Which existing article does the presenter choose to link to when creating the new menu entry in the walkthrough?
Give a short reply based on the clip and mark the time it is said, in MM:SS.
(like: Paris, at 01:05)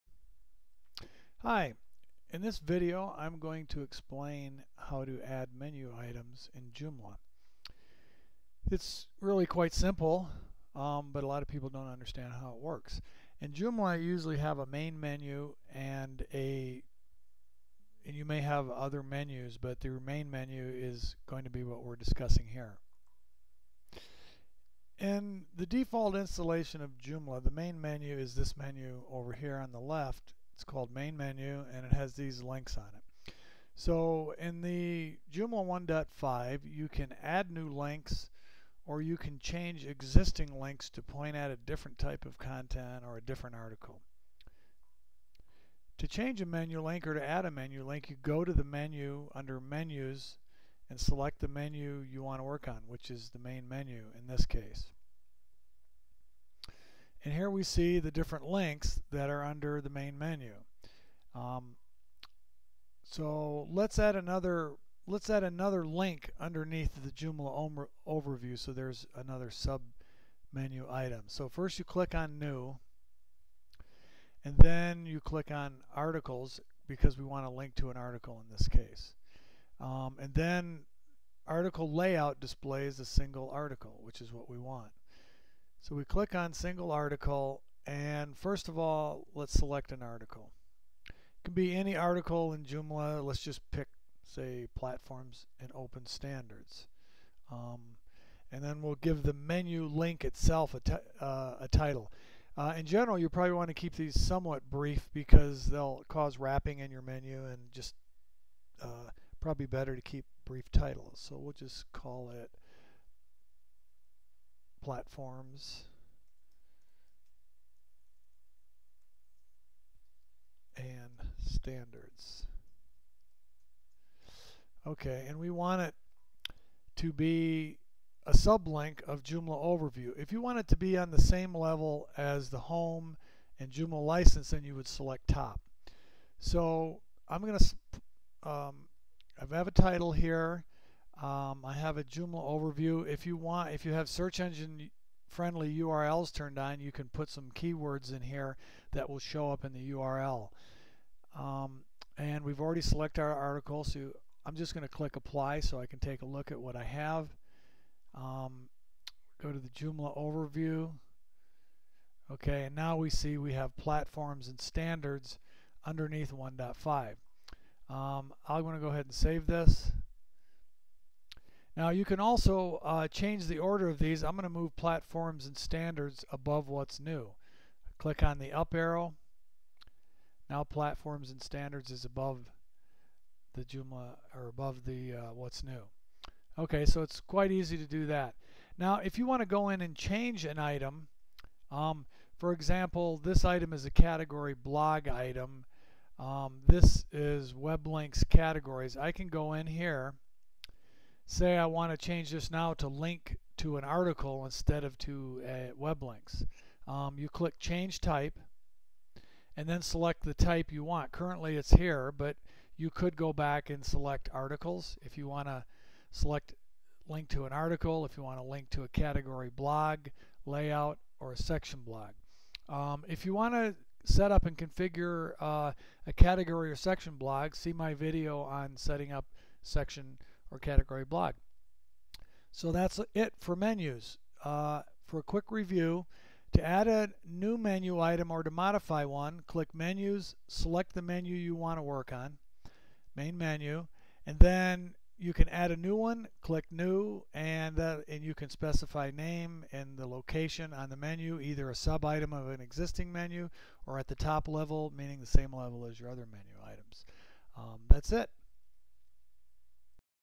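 Platforms and open standards, at 01:34.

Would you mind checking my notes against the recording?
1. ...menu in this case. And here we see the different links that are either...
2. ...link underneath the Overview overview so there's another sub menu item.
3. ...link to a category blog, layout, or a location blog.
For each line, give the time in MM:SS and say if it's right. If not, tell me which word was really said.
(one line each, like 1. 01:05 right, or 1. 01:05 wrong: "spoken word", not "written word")
1. 00:53 wrong: "under", not "either"
2. 01:05 wrong: "Joomla", not "Overview"
3. 03:38 wrong: "section", not "location".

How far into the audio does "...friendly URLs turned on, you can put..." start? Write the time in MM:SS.
02:25.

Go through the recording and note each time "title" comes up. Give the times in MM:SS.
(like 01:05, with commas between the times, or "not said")
01:41, 01:50, 02:19.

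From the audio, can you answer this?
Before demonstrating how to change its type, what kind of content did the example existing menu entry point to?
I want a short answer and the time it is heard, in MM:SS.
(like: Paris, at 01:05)
Web links categories, at 03:17.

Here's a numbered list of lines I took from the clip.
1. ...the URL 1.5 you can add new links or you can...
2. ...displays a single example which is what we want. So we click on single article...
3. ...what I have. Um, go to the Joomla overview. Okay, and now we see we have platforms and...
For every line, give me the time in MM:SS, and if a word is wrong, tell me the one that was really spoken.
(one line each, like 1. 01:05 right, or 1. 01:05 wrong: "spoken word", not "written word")
1. 00:34 wrong: "Joomla", not "URL"
2. 01:22 wrong: "article", not "example"
3. 02:36 right.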